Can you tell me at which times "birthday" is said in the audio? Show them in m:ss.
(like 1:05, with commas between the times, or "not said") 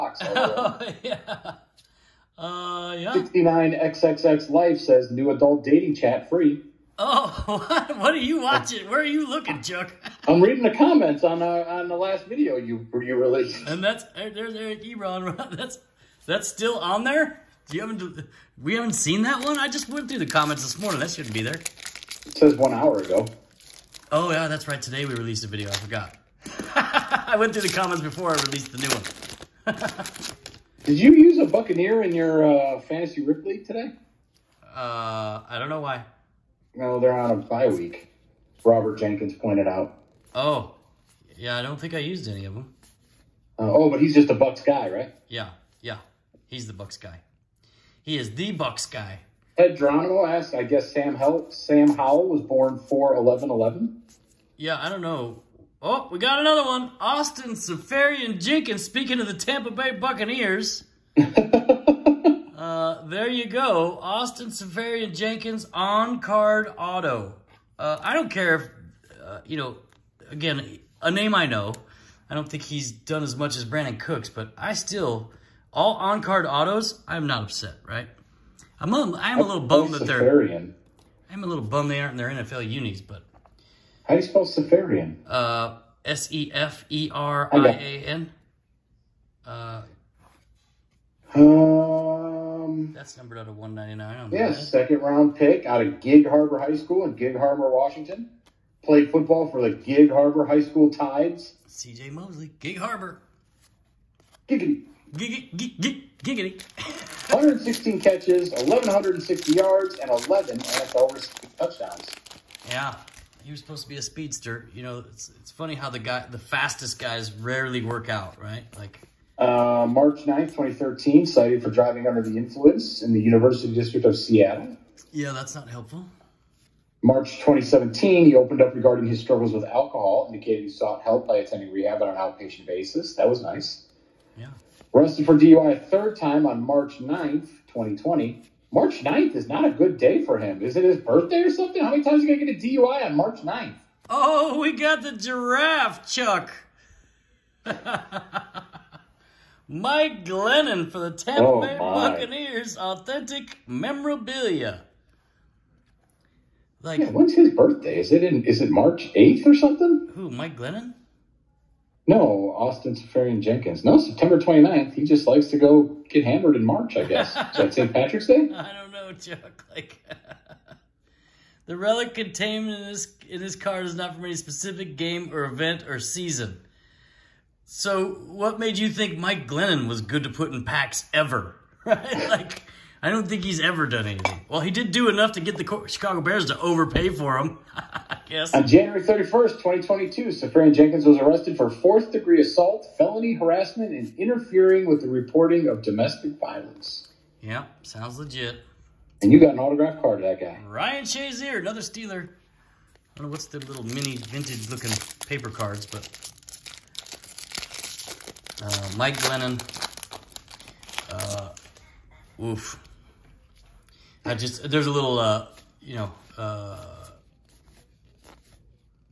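2:20, 2:37.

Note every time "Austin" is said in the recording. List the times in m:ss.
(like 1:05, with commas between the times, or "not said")
0:56, 1:03, 2:42.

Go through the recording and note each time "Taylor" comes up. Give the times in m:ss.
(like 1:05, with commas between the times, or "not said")
not said.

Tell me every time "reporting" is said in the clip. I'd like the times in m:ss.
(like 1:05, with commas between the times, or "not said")
3:15.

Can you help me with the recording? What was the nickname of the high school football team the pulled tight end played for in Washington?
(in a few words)
Tides.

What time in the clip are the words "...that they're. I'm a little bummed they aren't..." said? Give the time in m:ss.
1:19.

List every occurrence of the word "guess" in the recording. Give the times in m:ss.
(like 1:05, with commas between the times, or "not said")
0:50, 2:47.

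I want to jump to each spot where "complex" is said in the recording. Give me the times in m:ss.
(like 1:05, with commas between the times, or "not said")
not said.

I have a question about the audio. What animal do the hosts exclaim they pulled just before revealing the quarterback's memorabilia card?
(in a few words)
giraffe.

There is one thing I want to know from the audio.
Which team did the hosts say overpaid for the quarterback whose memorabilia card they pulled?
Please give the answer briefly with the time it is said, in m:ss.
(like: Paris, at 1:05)
Chicago Bears, at 3:05.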